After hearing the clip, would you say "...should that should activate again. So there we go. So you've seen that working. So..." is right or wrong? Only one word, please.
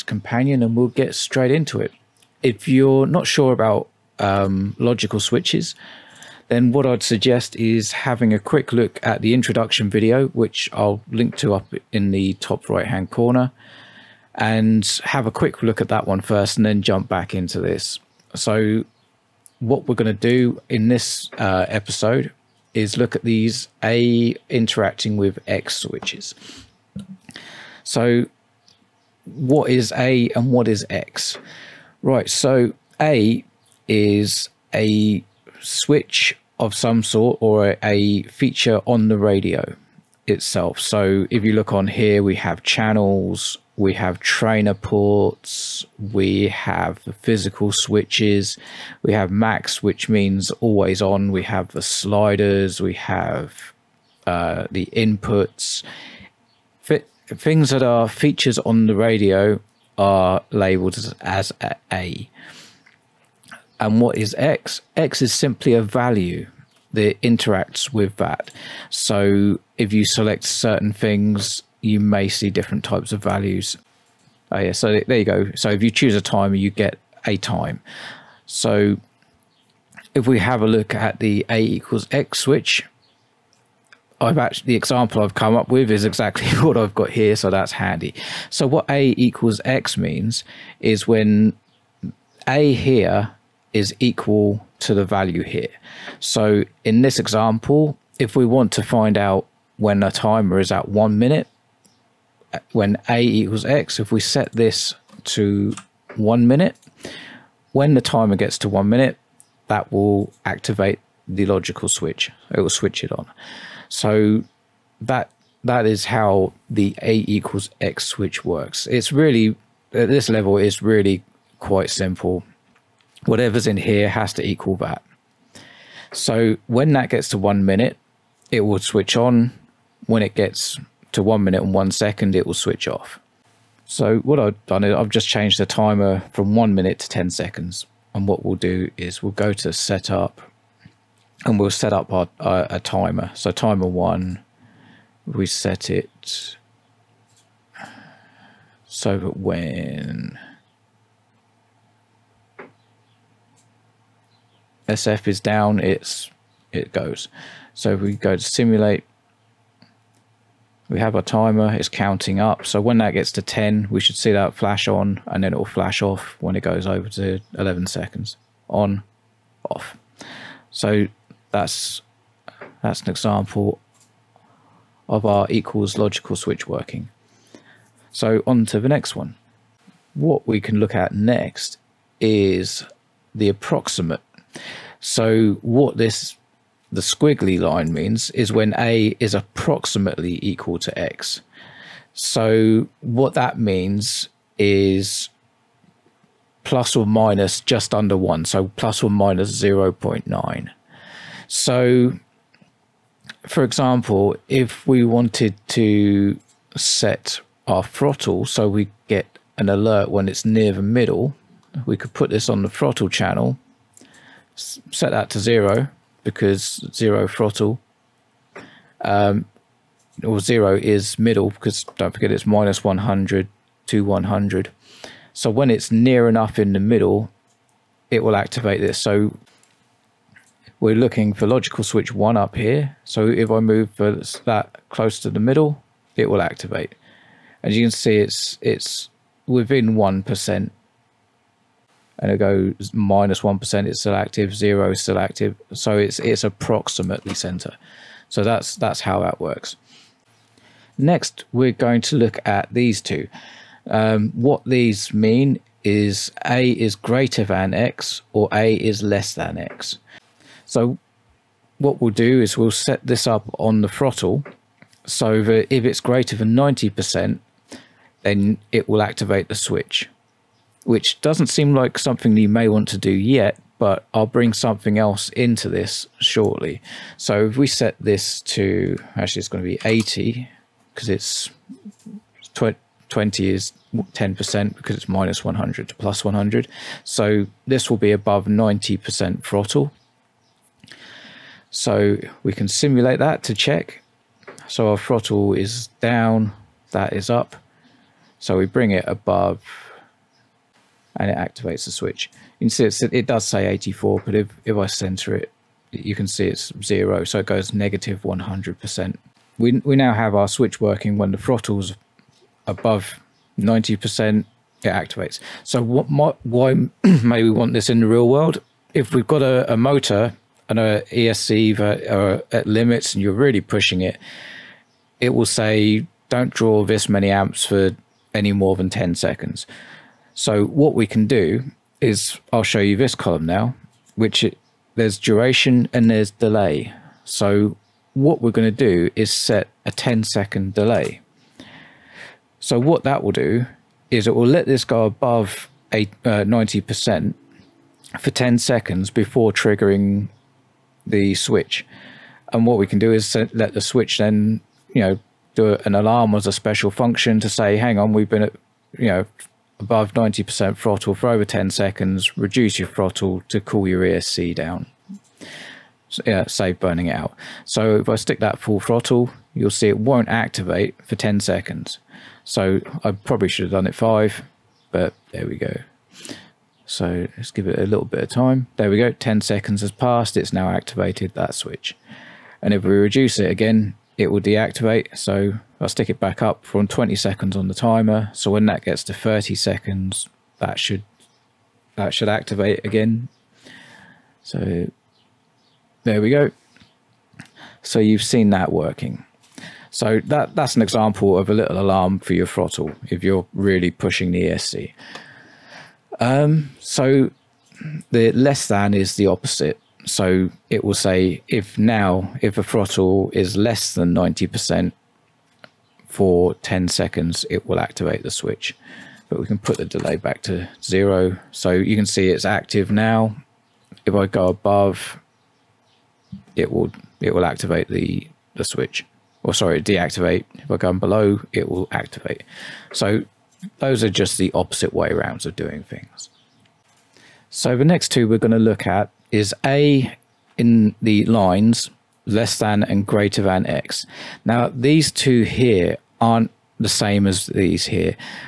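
right.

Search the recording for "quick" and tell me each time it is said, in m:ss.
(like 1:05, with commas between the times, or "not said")
0:08, 0:15.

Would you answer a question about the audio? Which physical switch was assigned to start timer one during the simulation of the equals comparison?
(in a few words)
SF.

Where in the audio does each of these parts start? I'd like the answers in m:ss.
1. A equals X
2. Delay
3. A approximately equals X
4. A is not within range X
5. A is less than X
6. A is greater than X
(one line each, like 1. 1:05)
1. 1:28
2. 5:37
3. 2:59
4. 7:15
5. 6:47
6. 4:09.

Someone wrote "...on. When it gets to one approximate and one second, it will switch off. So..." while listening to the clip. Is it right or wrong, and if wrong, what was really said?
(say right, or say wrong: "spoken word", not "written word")
wrong: "minute", not "approximate".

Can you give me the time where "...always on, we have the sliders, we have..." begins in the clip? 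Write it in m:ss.
0:50.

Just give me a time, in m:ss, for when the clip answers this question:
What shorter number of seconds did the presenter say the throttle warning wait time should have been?
6:13.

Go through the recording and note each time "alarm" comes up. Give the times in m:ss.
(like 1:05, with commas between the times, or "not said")
5:55, 6:41.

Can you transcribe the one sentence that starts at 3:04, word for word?
So what this the squiggly line means is when A is approximately equal to X.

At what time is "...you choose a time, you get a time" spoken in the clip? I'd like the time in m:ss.
1:15.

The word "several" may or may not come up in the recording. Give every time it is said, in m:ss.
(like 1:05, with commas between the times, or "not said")
not said.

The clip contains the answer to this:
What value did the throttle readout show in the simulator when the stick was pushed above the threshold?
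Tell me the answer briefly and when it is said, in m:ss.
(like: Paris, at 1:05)
84, at 5:03.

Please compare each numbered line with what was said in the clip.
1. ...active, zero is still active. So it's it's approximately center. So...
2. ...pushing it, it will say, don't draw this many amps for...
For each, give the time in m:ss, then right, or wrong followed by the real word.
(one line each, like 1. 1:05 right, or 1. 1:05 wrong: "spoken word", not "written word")
1. 4:04 right
2. 5:23 right.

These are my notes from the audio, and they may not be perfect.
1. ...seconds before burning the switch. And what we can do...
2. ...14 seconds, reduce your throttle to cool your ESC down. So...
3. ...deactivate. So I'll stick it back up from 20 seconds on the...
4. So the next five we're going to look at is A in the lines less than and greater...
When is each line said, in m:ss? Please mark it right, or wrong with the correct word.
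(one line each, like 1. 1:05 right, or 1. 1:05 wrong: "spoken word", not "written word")
1. 5:48 wrong: "triggering", not "burning"
2. 6:01 wrong: "10", not "14"
3. 6:24 right
4. 7:17 wrong: "two", not "five".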